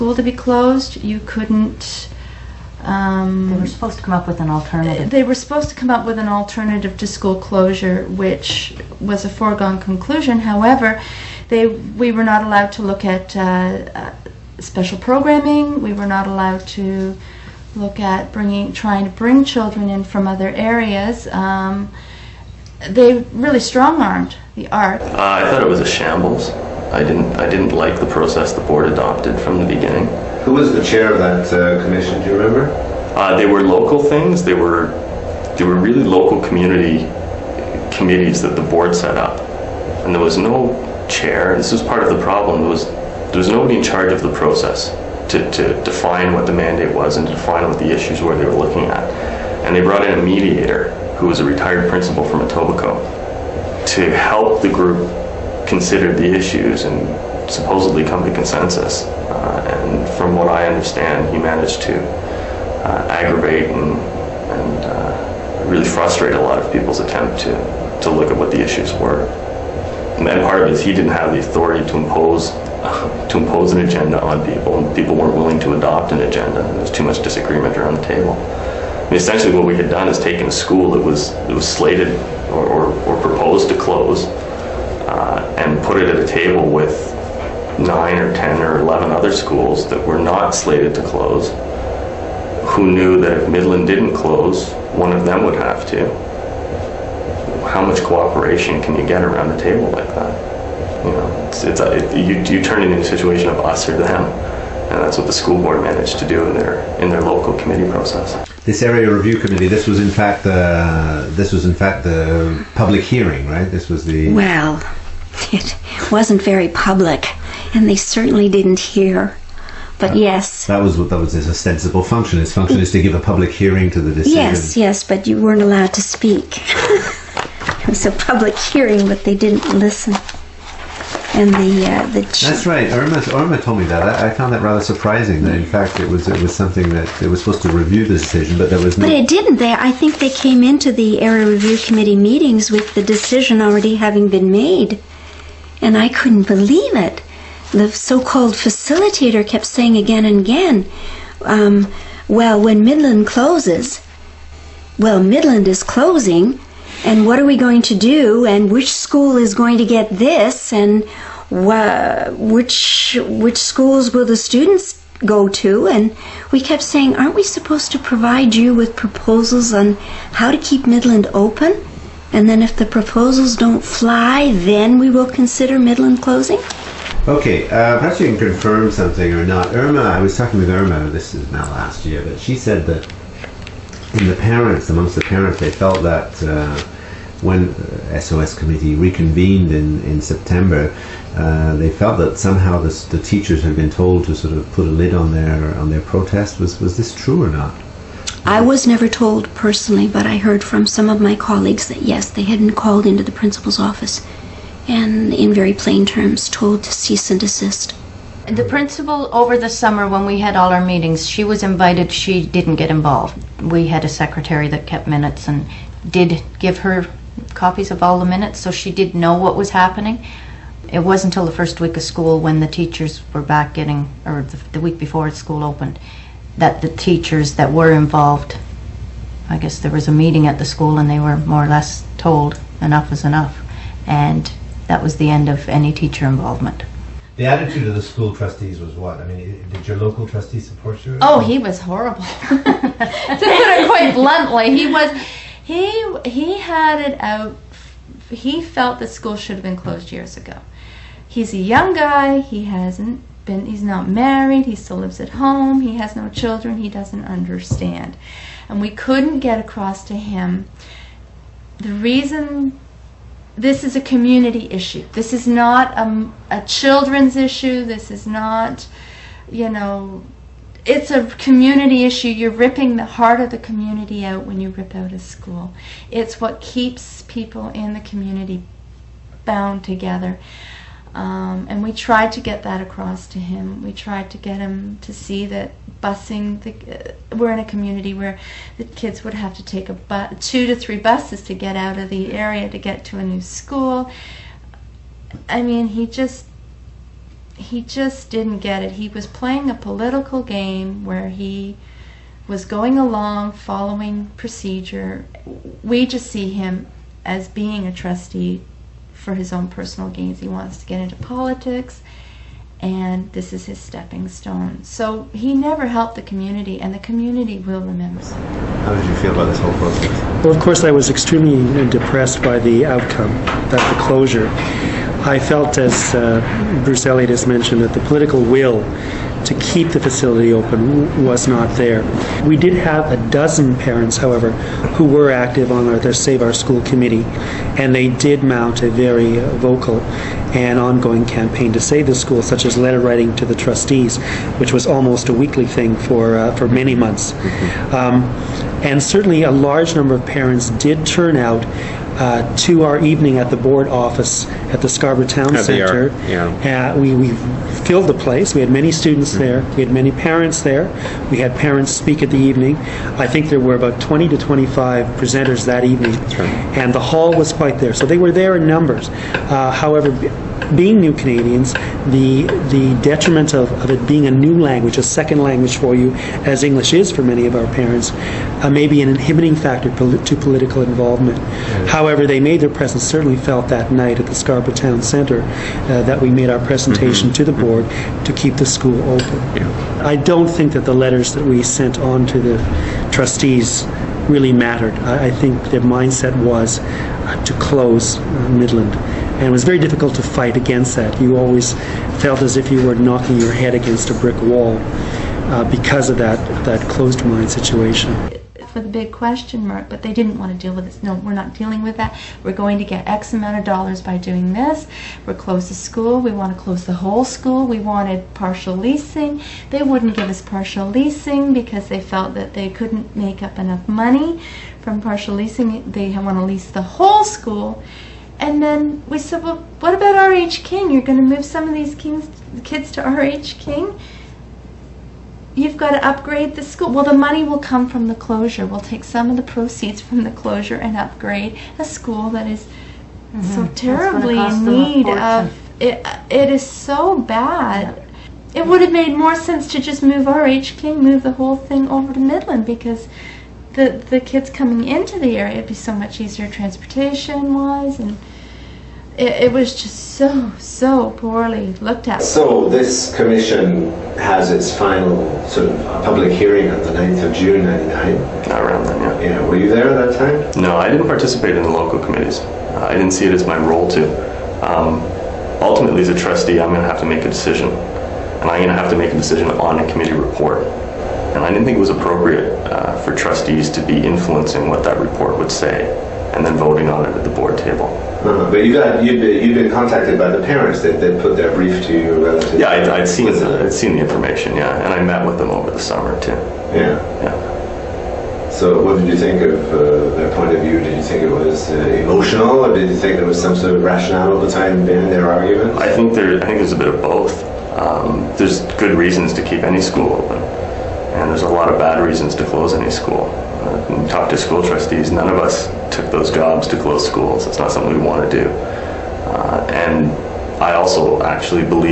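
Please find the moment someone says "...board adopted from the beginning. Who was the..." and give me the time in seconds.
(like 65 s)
28 s.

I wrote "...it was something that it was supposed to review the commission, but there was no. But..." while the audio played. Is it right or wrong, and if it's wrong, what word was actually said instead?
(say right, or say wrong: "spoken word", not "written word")
wrong: "decision", not "commission".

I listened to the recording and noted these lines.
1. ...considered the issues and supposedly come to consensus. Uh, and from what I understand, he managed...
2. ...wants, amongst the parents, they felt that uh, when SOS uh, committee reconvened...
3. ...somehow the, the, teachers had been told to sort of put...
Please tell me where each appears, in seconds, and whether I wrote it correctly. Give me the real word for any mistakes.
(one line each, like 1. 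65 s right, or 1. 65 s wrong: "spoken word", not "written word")
1. 55 s right
2. 184 s wrong: "parents", not "wants"
3. 192 s right.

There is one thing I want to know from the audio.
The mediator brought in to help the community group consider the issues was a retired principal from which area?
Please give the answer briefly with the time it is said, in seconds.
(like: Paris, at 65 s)
Etobicoke, at 52 s.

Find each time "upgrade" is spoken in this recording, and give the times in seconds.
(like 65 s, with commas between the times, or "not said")
436 s, 440 s.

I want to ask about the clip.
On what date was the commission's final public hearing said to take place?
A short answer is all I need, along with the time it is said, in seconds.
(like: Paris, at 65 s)
June 9, at 466 s.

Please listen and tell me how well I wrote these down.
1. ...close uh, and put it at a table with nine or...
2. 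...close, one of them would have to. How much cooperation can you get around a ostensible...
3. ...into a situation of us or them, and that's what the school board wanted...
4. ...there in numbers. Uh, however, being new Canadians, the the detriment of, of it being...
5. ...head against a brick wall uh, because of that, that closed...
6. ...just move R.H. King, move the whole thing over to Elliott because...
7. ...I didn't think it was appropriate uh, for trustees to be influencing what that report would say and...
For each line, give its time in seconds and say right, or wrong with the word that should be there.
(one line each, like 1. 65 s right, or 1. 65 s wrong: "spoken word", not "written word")
1. 83 s right
2. 94 s wrong: "table", not "ostensible"
3. 102 s wrong: "managed", not "wanted"
4. 368 s right
5. 403 s right
6. 449 s wrong: "Midland", not "Elliott"
7. 481 s right.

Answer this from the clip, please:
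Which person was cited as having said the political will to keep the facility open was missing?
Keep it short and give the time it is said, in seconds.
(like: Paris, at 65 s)
Bruce Elliott, at 326 s.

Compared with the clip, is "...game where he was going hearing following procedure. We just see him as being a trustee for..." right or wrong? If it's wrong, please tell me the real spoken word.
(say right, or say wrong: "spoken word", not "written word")
wrong: "along", not "hearing".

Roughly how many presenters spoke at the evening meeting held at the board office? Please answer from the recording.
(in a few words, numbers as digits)
20 to 25.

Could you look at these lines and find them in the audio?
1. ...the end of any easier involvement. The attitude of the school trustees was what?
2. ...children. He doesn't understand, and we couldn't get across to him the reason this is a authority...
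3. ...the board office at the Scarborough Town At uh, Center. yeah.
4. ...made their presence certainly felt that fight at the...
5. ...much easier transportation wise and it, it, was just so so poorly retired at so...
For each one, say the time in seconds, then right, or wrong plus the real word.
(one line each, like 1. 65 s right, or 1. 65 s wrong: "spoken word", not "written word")
1. 235 s wrong: "teacher", not "easier"
2. 256 s wrong: "community", not "authority"
3. 353 s right
4. 382 s wrong: "night", not "fight"
5. 455 s wrong: "looked", not "retired".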